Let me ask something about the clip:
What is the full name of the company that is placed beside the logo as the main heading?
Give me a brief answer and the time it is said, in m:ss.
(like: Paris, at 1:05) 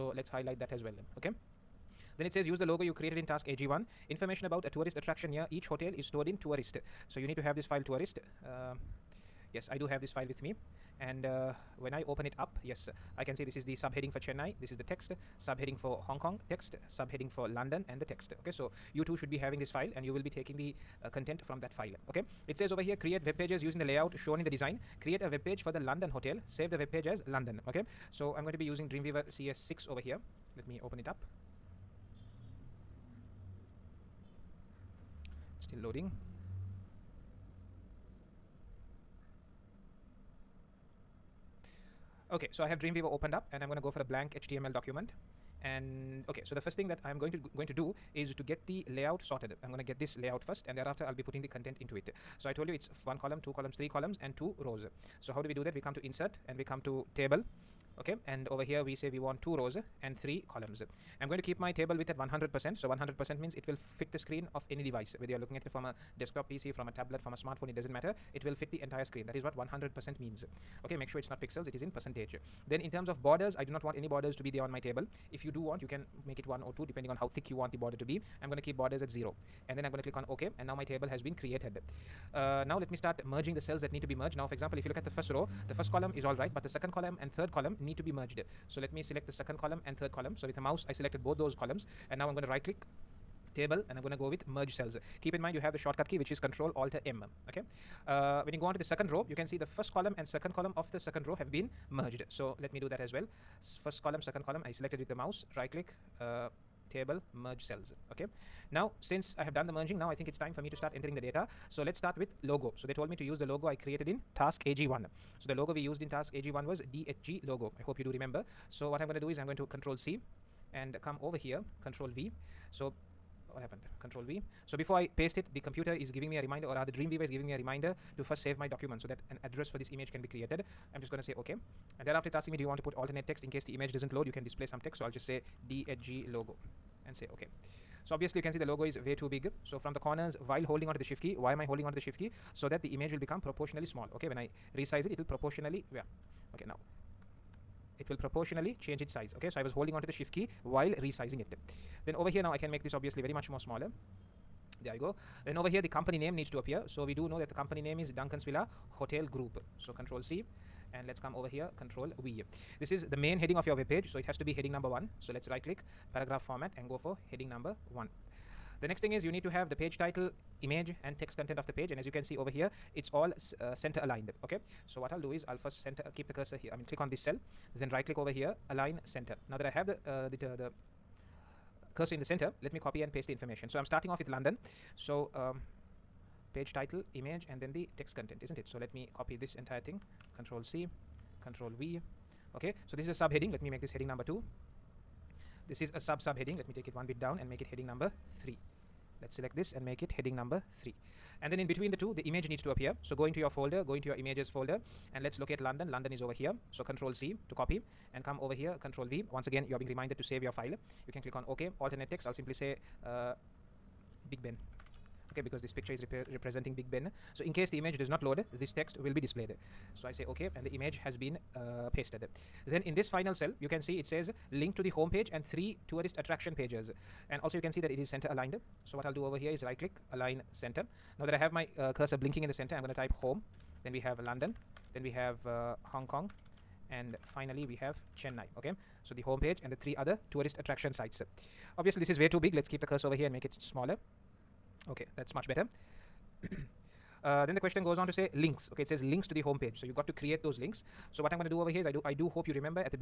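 Duncan's Villa Hotel Group, at 2:38.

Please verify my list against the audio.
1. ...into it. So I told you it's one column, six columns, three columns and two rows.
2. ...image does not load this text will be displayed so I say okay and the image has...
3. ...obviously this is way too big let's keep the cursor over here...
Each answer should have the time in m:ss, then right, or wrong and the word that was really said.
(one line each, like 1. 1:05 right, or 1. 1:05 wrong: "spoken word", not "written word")
1. 0:51 wrong: "two", not "six"
2. 3:37 right
3. 4:01 right.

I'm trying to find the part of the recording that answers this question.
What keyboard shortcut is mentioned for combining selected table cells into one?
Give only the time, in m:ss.
1:36.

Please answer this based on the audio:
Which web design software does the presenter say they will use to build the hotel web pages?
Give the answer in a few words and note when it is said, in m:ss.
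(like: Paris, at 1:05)
Dreamweaver CS6, at 0:28.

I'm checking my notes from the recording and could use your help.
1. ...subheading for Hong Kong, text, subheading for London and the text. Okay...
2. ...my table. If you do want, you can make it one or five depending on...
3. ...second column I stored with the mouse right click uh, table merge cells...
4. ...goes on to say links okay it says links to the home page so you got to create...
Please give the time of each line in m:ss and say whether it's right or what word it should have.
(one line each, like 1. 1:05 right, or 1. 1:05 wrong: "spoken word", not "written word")
1. 0:15 right
2. 1:14 wrong: "two", not "five"
3. 1:44 wrong: "selected", not "stored"
4. 4:07 right.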